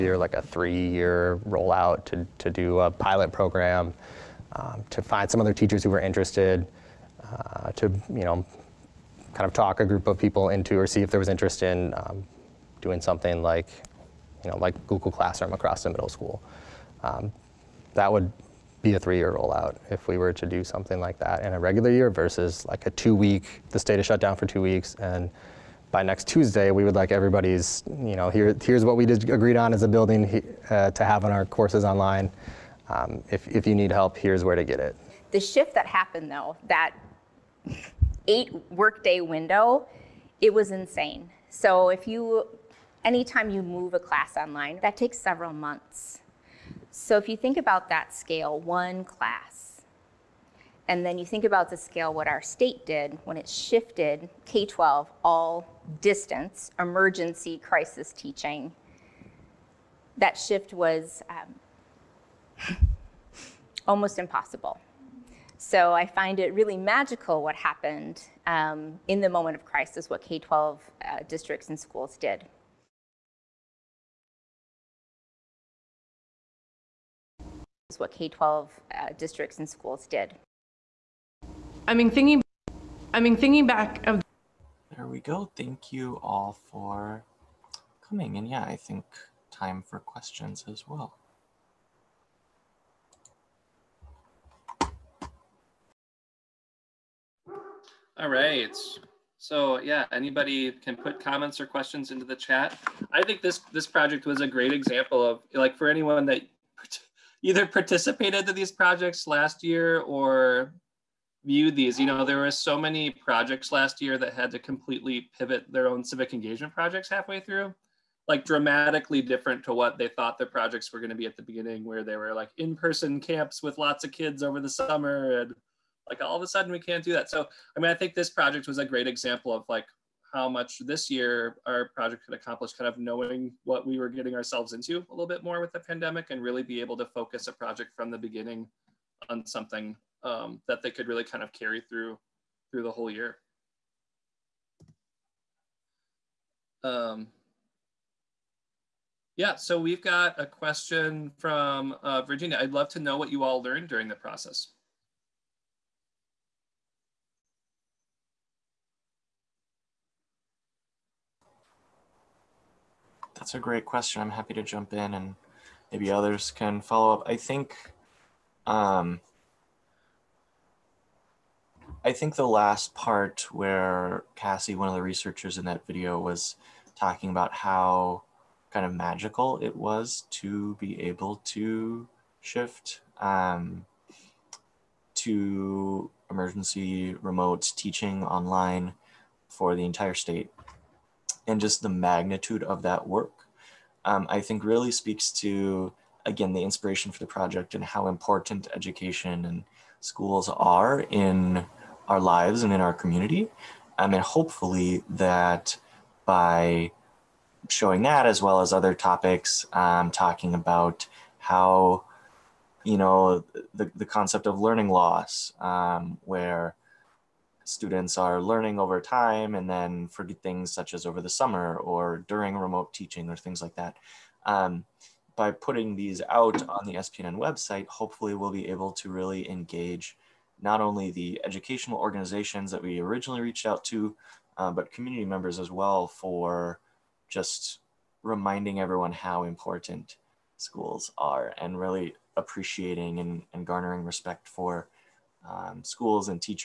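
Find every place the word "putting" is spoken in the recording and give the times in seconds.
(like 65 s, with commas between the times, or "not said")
225 s.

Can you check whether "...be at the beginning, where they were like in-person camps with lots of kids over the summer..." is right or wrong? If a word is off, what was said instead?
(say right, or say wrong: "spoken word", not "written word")
right.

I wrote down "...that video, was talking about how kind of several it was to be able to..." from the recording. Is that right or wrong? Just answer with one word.
wrong.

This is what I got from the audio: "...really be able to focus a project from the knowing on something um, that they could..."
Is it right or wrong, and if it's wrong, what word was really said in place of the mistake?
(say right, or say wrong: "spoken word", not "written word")
wrong: "beginning", not "knowing".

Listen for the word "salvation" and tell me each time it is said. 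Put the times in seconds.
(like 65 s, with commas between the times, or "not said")
not said.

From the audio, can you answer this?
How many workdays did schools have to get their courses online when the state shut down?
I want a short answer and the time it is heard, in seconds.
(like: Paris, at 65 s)
8, at 38 s.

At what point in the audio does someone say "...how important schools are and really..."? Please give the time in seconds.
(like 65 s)
239 s.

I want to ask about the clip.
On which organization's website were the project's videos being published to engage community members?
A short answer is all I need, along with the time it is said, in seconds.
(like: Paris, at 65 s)
SPNN, at 226 s.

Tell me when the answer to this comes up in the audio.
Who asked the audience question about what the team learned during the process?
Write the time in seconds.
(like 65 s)
152 s.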